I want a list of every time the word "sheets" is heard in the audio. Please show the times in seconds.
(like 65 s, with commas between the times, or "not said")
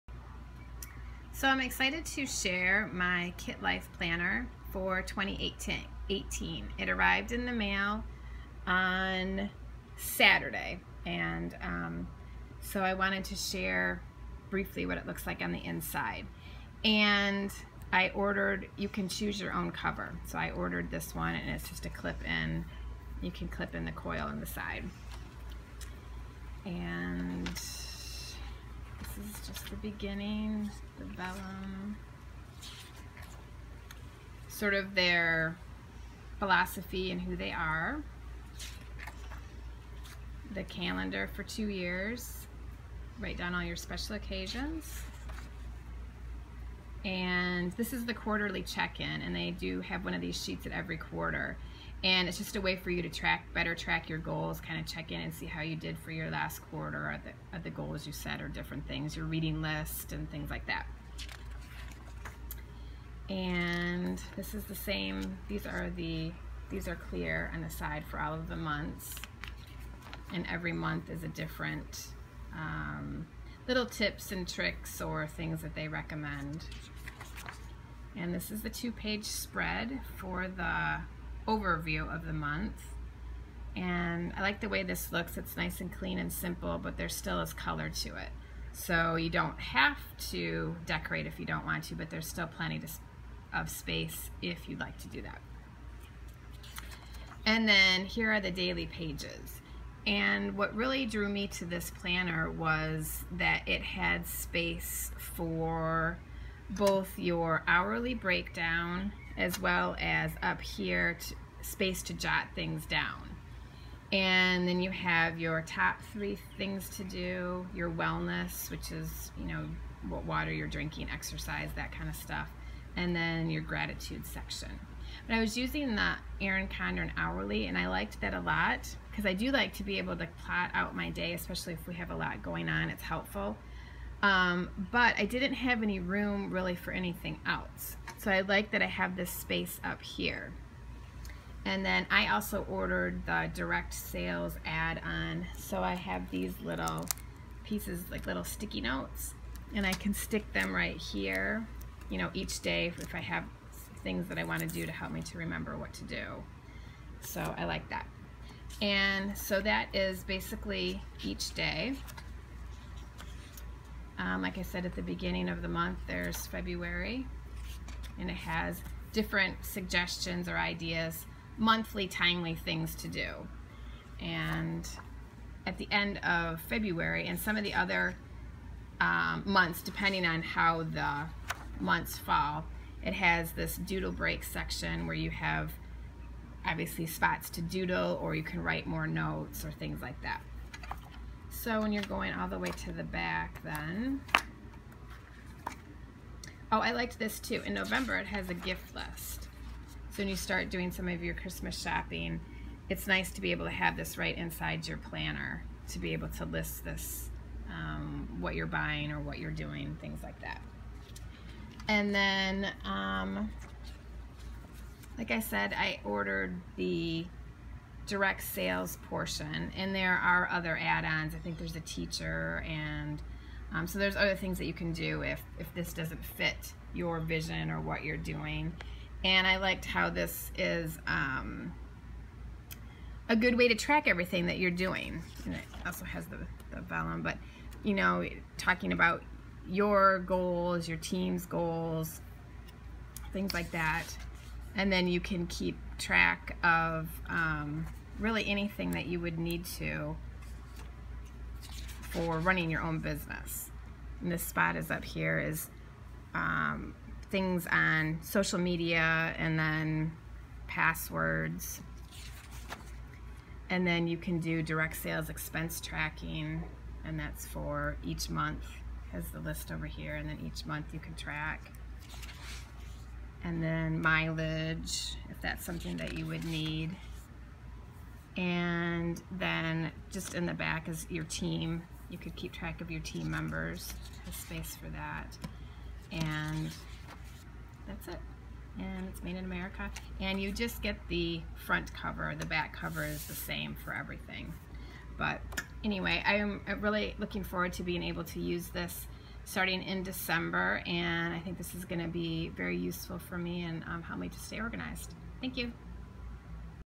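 50 s.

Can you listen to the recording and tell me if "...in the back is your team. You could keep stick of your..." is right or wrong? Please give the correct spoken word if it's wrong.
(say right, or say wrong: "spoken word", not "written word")
wrong: "track", not "stick".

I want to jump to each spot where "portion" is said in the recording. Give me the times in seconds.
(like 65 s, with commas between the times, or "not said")
219 s.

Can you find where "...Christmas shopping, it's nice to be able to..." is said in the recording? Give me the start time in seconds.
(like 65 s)
201 s.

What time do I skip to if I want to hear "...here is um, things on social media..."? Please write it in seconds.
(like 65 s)
255 s.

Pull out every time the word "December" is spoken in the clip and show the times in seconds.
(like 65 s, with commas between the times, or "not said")
300 s.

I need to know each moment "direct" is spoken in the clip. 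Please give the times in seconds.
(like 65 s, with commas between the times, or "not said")
143 s, 218 s, 264 s.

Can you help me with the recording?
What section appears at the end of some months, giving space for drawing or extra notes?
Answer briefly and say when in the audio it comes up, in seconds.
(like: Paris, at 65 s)
doodle break, at 183 s.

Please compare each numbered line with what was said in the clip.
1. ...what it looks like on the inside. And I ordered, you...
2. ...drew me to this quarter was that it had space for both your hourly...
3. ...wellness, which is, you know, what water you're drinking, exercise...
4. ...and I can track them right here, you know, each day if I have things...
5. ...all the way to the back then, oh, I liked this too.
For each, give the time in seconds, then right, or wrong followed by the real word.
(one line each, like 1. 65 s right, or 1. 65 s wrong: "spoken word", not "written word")
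1. 14 s right
2. 101 s wrong: "planner", not "quarter"
3. 117 s right
4. 149 s wrong: "stick", not "track"
5. 192 s right.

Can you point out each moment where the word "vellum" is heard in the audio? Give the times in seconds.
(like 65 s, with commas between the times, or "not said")
31 s, 236 s.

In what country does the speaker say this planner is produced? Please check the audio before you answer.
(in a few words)
America.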